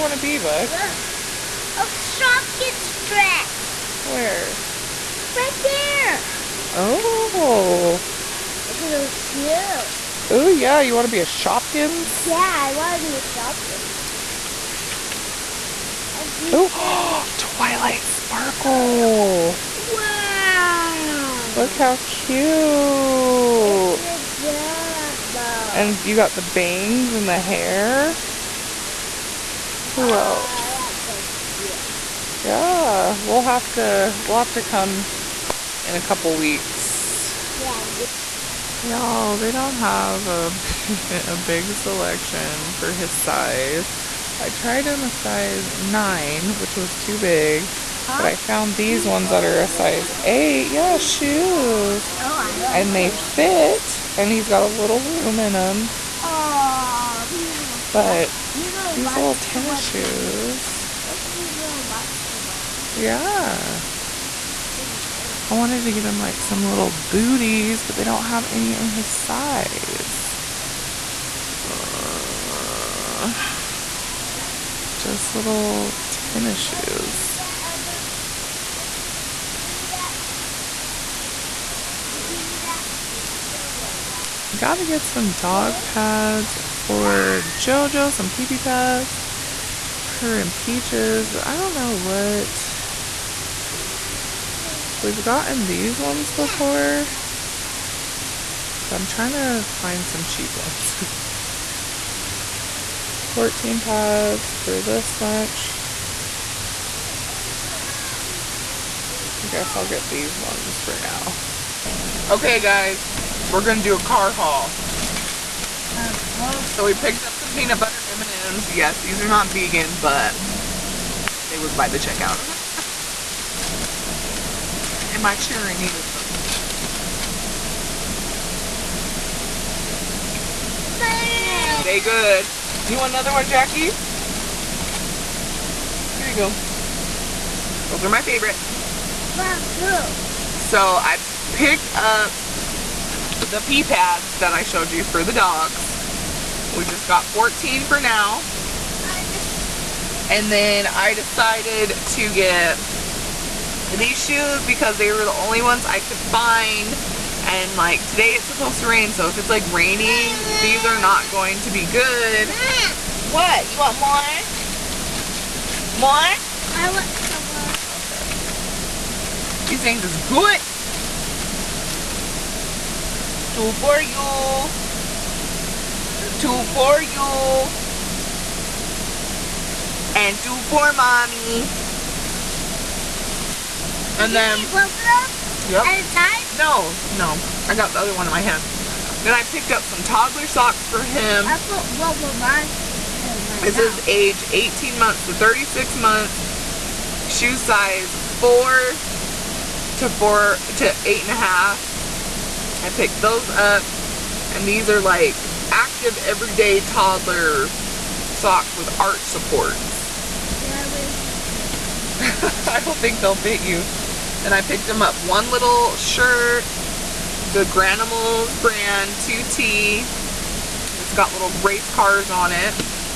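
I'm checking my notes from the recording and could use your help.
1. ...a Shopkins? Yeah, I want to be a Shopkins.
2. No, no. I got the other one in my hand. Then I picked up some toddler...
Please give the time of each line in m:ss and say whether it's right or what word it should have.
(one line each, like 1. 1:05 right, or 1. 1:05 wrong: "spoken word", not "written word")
1. 0:11 right
2. 3:06 right.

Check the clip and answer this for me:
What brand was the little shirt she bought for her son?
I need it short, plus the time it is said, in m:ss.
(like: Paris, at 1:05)
Granimals, at 3:37.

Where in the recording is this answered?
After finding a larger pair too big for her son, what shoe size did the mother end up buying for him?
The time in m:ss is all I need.
0:49.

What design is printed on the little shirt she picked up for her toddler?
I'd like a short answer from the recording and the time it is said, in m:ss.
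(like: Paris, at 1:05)
Race cars, at 3:41.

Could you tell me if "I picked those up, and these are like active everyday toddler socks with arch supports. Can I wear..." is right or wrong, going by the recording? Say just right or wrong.
right.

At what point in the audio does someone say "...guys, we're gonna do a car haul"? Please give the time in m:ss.
1:52.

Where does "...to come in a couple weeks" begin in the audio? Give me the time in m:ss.
0:34.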